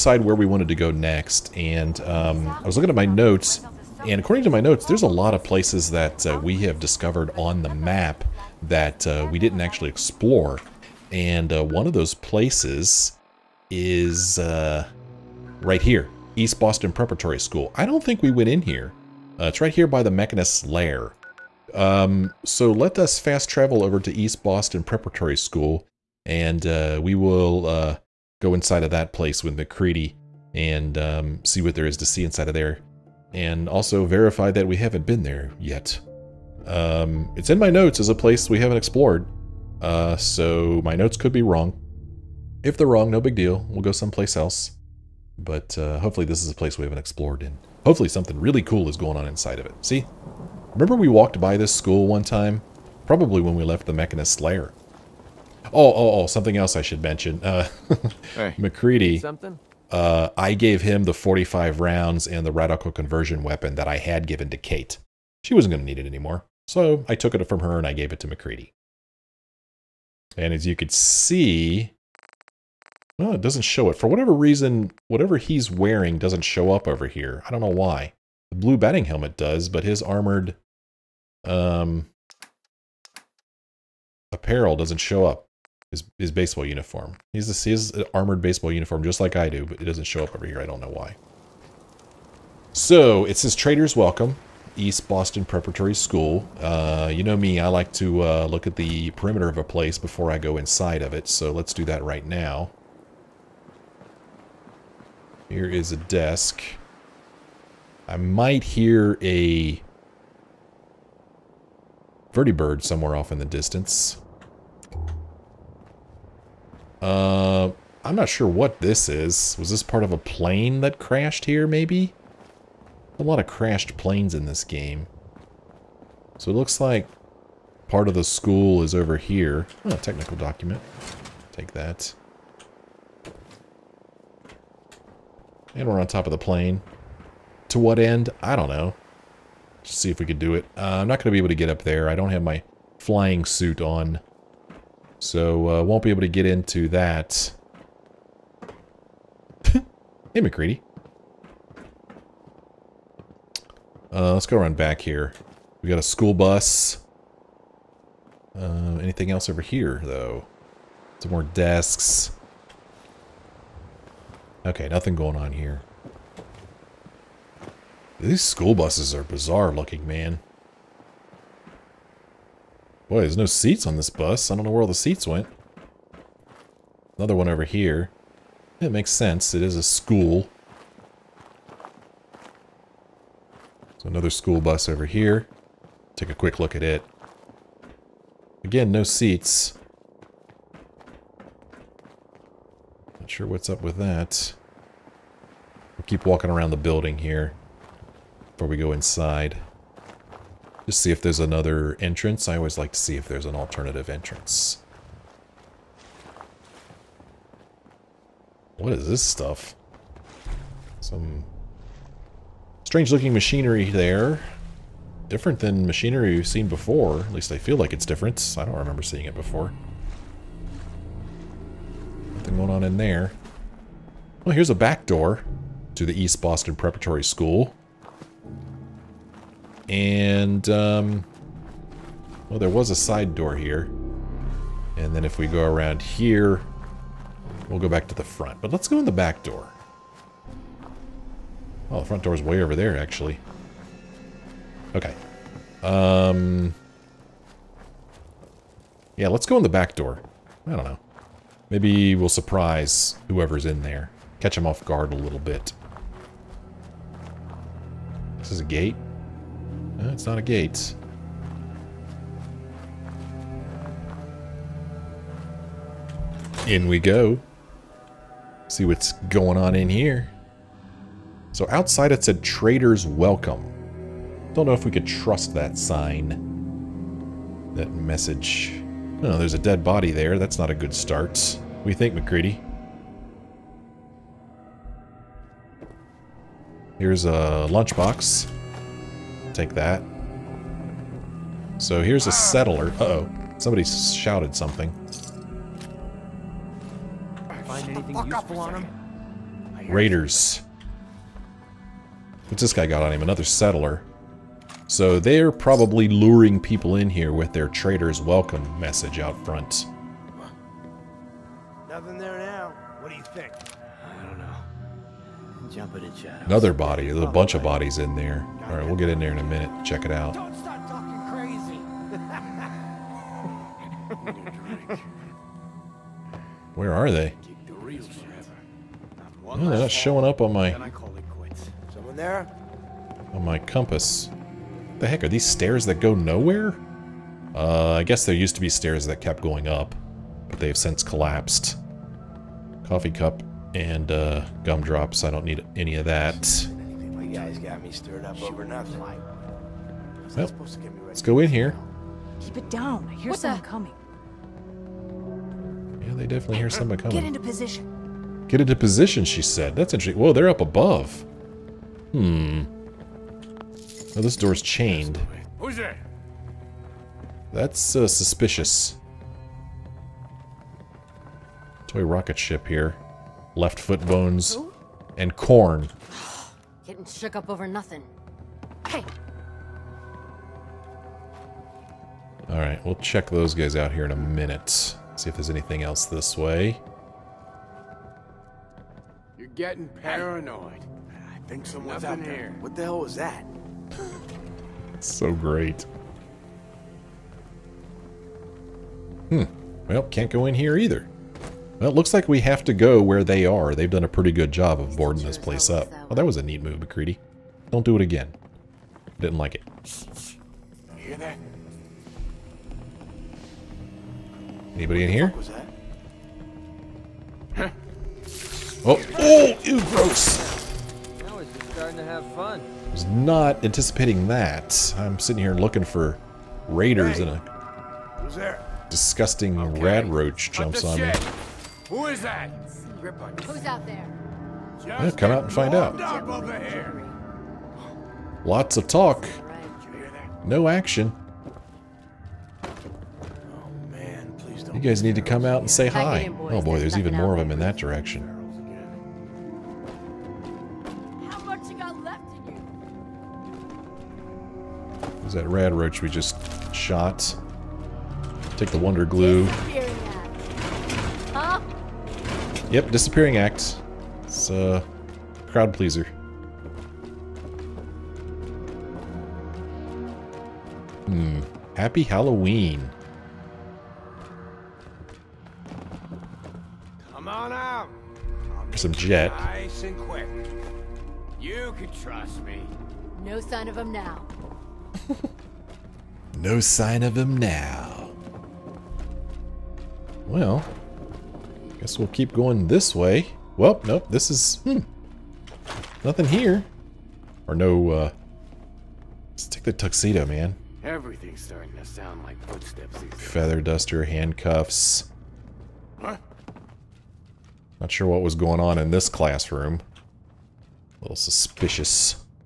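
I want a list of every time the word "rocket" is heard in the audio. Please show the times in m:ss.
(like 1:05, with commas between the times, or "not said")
6:12.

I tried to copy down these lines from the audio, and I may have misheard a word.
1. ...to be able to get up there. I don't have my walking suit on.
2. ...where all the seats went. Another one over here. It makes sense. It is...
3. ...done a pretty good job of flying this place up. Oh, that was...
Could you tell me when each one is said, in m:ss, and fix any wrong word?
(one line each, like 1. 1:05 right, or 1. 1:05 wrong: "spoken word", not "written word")
1. 2:21 wrong: "flying", not "walking"
2. 2:54 right
3. 6:43 wrong: "boarding", not "flying".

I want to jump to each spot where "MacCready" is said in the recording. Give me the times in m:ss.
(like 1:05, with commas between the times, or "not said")
0:29, 0:58, 1:08, 2:30, 4:42, 6:46.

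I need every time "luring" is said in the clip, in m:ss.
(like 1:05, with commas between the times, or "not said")
5:06.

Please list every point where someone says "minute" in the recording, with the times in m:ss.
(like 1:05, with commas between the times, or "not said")
5:19, 6:24.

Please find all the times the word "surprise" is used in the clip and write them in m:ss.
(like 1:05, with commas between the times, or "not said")
4:12.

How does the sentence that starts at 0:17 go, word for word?
I don't think we went in here.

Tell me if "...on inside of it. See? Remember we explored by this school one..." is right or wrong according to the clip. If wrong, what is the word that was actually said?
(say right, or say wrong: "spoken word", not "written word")
wrong: "walked", not "explored".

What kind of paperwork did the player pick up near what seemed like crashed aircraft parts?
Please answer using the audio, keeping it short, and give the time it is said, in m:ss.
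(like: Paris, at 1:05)
technical document, at 2:09.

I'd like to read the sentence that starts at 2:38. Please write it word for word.
Uh, anything else over here, though?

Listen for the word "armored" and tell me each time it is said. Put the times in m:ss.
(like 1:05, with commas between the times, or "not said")
1:20, 1:28.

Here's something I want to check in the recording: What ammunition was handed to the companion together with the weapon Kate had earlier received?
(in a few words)
45 rounds.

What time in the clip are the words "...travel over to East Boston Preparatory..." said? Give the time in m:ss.
0:23.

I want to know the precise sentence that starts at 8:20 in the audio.
Everything's starting to sound like footsteps Feather duster, handcuffs.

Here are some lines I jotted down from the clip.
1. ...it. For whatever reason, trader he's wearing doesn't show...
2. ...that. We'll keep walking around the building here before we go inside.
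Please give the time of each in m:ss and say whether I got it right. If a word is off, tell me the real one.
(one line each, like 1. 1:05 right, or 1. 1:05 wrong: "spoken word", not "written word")
1. 1:13 wrong: "whatever", not "trader"
2. 3:13 right.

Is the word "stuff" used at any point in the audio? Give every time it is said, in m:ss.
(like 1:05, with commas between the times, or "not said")
3:29.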